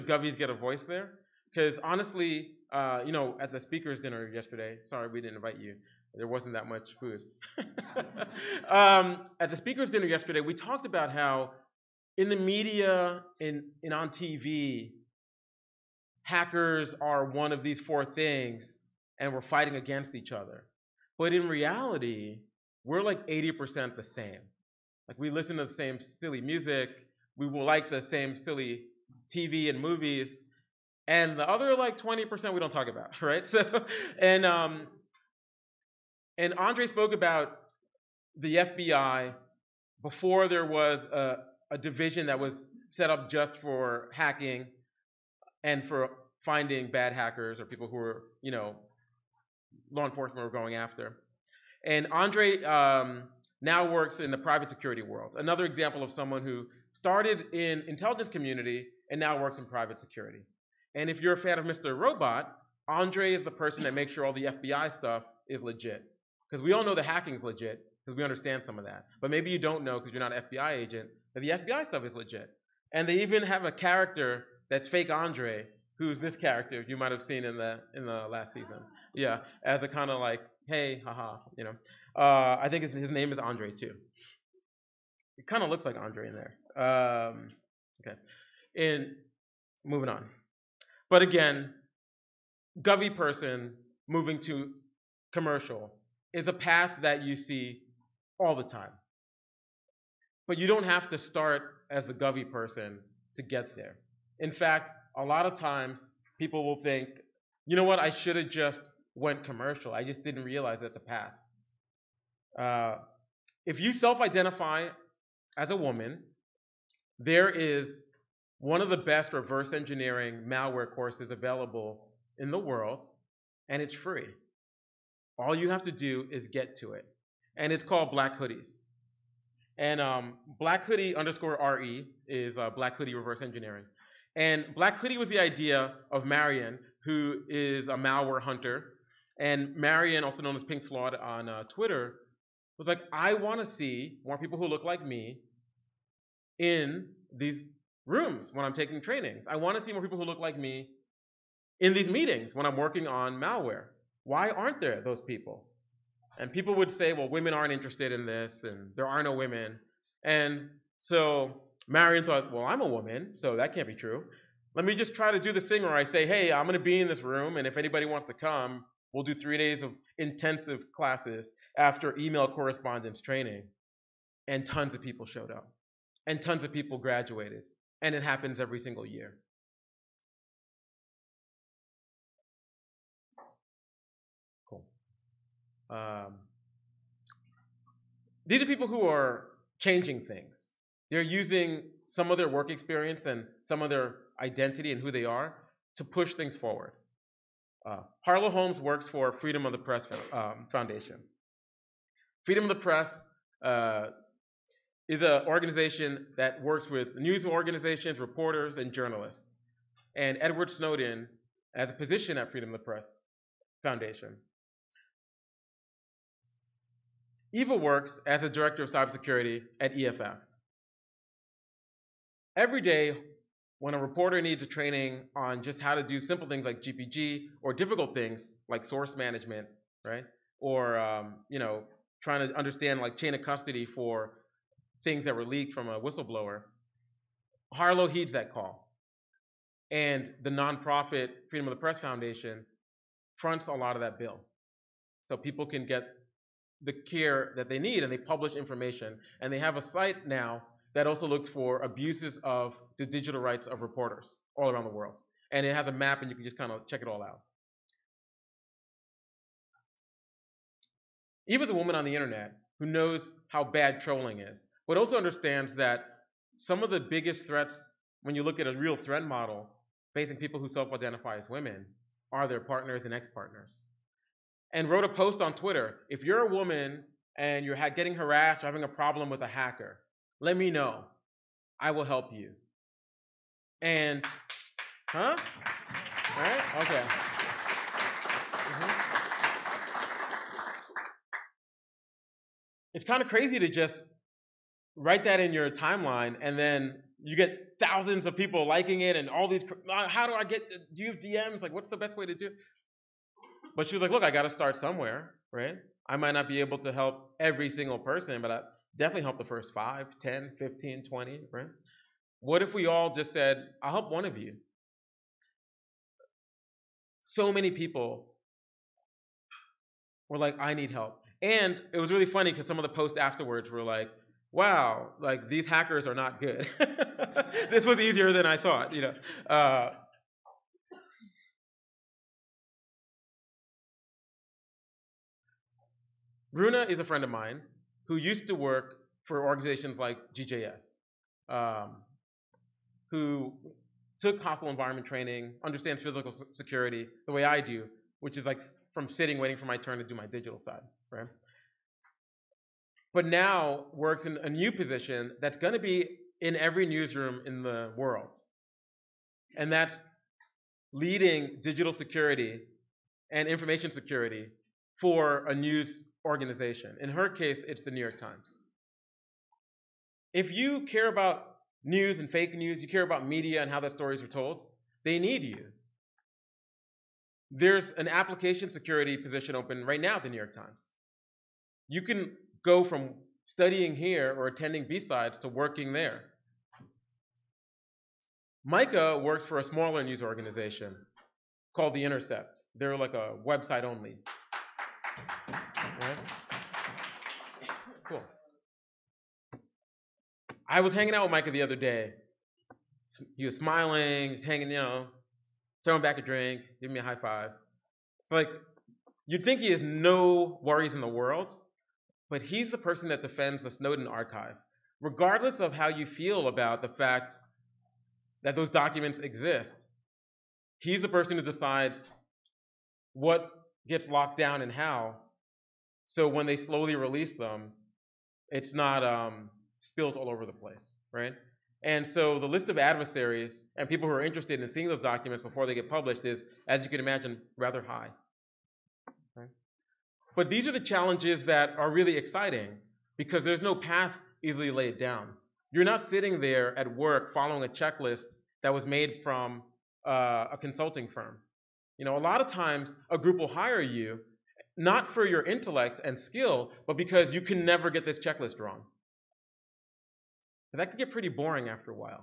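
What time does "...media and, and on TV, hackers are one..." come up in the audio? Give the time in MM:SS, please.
00:12.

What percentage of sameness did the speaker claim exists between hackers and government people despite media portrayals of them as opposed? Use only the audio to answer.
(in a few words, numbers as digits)
80%.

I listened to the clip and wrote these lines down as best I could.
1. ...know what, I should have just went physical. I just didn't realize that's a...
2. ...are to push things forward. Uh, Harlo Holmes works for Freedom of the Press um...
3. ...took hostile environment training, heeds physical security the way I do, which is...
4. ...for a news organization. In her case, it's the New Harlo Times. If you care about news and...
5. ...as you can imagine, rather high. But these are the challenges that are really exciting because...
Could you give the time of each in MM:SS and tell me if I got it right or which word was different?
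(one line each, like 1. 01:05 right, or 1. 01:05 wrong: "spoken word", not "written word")
1. 01:47 wrong: "commercial", not "physical"
2. 03:15 right
3. 05:44 wrong: "understands", not "heeds"
4. 06:04 wrong: "York", not "Harlo"
5. 07:16 right.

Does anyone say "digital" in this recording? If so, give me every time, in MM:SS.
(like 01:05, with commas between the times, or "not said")
04:13, 05:50, 06:01.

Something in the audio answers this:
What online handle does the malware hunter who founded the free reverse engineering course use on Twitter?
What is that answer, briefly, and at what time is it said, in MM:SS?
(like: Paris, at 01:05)
pinkflawd, at 02:20.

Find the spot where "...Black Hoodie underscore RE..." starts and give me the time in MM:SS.
02:10.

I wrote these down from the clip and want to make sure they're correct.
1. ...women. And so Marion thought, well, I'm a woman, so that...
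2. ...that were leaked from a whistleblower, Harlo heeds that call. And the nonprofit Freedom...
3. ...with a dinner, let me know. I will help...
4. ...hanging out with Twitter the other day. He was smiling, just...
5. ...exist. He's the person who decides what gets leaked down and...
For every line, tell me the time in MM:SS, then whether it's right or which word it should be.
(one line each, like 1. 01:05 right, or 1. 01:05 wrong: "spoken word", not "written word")
1. 02:39 right
2. 03:55 right
3. 04:39 wrong: "hacker", not "dinner"
4. 06:40 wrong: "Micah", not "Twitter"
5. 06:59 wrong: "locked", not "leaked".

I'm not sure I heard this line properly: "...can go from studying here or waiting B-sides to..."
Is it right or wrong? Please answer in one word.
wrong.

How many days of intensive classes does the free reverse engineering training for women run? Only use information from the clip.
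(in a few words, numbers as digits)
3.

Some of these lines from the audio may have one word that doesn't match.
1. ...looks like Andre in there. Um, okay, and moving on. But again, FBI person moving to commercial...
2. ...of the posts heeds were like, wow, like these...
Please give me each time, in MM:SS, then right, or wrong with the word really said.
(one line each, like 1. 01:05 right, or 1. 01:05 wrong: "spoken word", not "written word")
1. 01:25 wrong: "Govey", not "FBI"
2. 05:22 wrong: "afterwards", not "heeds".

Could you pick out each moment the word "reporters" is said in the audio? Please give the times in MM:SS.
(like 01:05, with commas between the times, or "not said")
03:28, 03:43, 04:13.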